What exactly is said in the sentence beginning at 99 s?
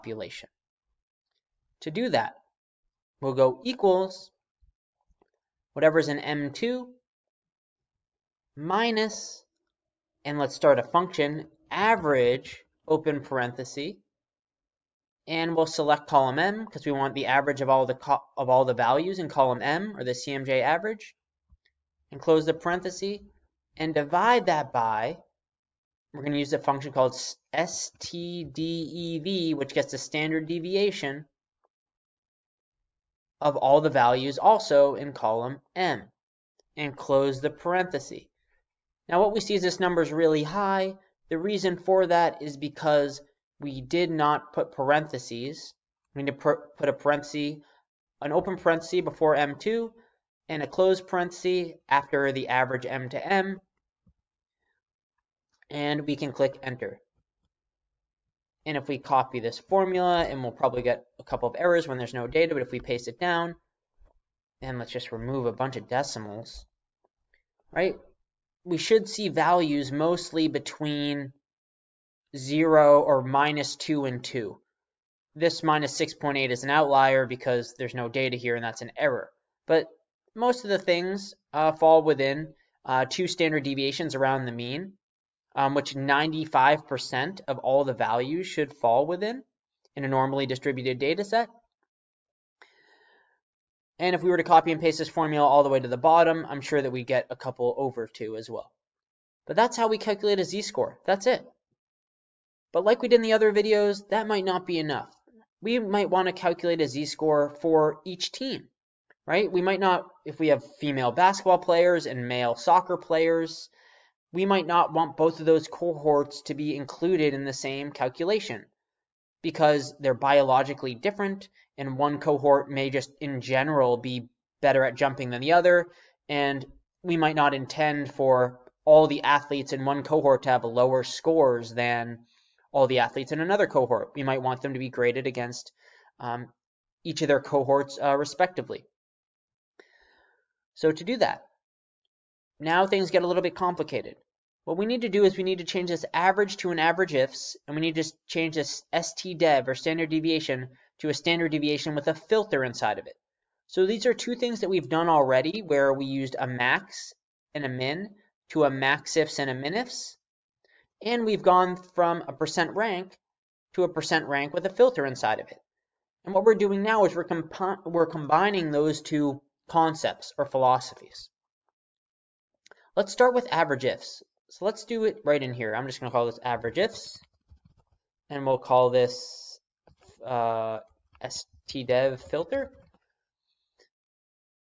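But that's how we calculate a z-score.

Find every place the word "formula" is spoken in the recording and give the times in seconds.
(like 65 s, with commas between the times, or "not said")
59 s, 95 s.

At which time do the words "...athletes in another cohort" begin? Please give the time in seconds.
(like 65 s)
133 s.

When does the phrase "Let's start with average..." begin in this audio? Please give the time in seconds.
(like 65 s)
172 s.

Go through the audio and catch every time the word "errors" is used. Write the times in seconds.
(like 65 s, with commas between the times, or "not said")
61 s, 78 s.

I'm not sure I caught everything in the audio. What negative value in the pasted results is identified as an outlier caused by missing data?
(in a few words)
-6.8.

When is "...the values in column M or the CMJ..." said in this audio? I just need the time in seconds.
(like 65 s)
18 s.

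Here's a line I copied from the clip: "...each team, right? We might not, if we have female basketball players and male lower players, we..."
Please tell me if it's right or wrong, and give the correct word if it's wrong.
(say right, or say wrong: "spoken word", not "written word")
wrong: "soccer", not "lower".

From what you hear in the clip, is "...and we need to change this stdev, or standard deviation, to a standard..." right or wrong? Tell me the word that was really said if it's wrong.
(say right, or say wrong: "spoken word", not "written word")
right.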